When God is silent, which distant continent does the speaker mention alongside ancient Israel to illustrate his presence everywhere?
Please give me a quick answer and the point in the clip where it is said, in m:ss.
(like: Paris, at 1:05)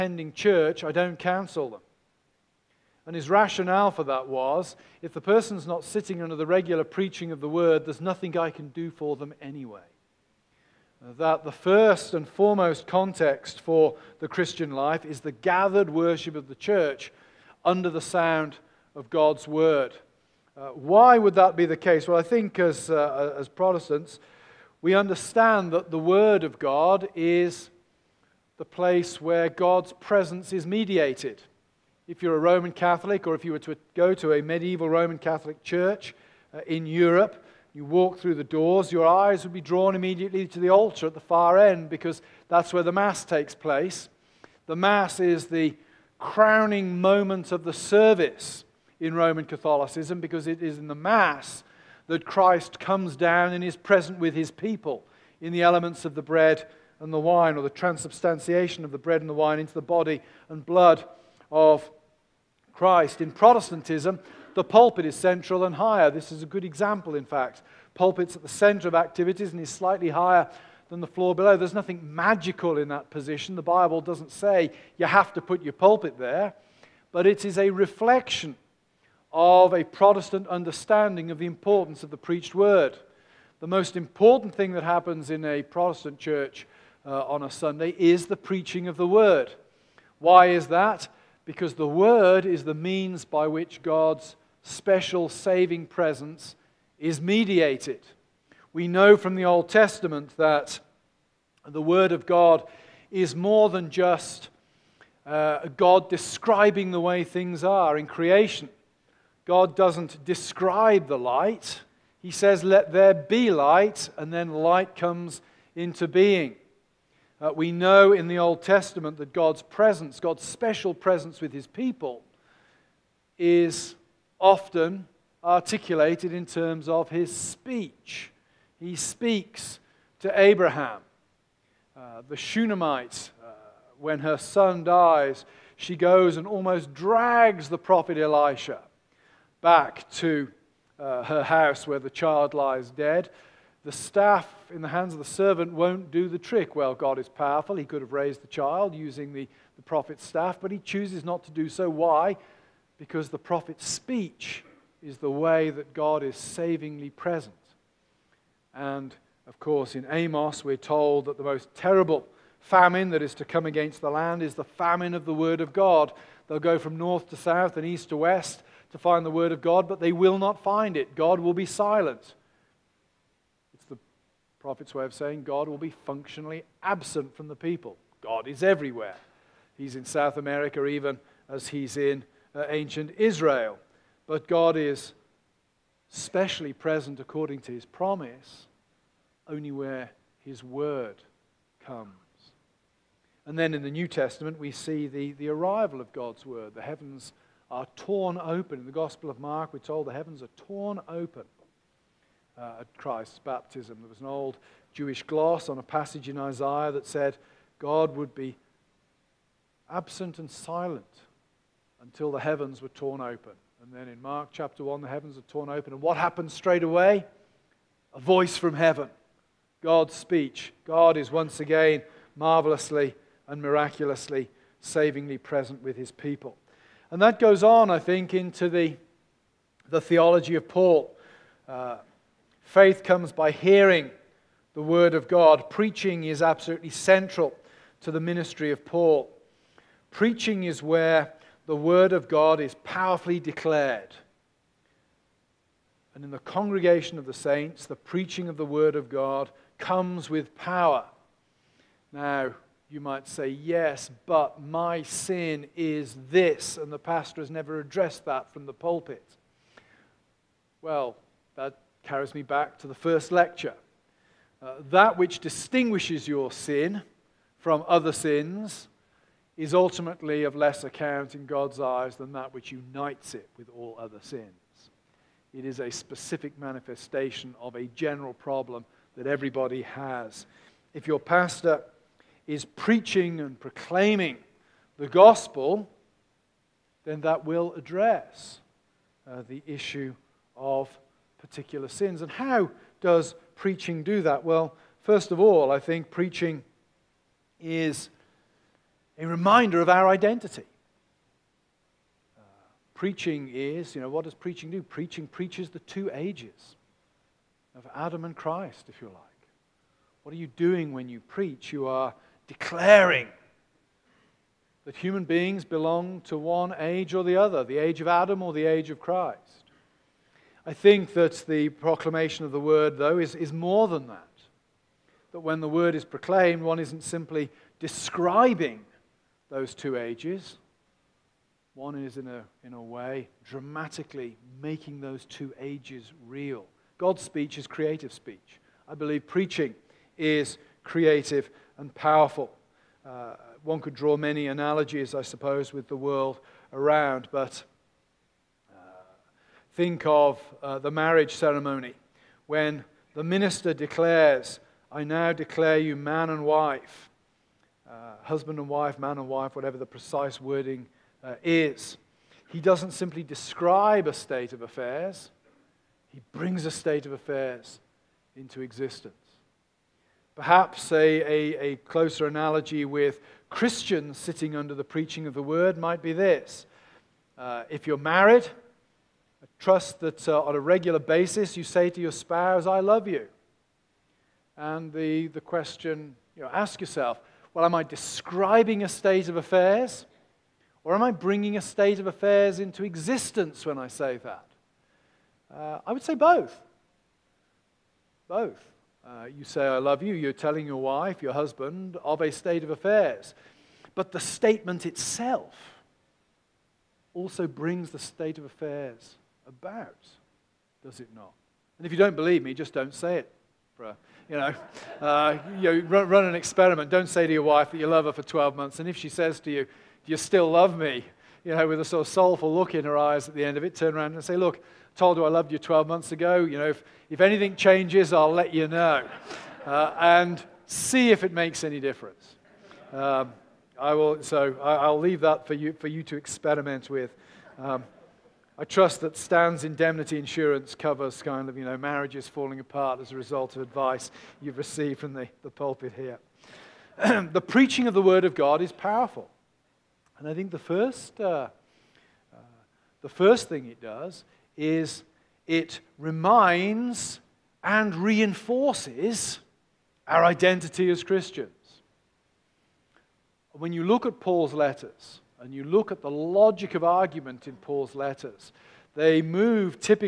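South America, at 3:00.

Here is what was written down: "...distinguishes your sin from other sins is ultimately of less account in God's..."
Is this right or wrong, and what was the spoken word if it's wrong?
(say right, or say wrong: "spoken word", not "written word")
right.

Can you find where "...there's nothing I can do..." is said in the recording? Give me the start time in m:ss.
0:07.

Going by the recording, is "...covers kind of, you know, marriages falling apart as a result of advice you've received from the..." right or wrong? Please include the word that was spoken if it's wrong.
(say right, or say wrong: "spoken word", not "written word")
right.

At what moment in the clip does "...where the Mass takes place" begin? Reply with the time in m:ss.
0:42.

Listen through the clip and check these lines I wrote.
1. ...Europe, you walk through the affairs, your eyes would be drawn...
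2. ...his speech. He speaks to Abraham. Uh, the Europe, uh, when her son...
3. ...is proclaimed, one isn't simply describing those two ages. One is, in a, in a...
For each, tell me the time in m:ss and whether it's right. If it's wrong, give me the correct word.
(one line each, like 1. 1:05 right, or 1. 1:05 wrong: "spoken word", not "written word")
1. 0:36 wrong: "doors", not "affairs"
2. 2:07 wrong: "Shunammite", not "Europe"
3. 5:25 right.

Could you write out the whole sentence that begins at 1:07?
Pulpit's at the center of activities and is slightly higher than the floor below.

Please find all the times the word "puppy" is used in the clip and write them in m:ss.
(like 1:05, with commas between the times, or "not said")
not said.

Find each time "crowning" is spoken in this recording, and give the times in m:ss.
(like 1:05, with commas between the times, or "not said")
0:46.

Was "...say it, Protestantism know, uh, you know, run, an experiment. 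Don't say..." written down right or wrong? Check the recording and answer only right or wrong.
wrong.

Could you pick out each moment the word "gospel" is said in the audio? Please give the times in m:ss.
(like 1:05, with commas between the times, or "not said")
3:18, 4:45.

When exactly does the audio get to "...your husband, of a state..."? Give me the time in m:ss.
6:41.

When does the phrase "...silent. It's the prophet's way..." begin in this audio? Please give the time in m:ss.
2:51.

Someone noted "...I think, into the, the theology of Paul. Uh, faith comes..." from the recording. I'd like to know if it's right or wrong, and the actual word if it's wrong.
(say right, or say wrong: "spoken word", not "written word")
right.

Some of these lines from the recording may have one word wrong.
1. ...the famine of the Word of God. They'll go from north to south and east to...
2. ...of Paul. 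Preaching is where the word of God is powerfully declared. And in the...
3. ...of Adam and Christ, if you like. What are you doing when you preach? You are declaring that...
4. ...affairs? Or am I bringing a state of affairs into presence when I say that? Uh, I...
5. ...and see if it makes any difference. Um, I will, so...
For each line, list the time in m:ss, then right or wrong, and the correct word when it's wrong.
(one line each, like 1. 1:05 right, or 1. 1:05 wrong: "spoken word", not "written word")
1. 2:44 right
2. 3:58 right
3. 5:07 right
4. 6:29 wrong: "existence", not "presence"
5. 7:09 right.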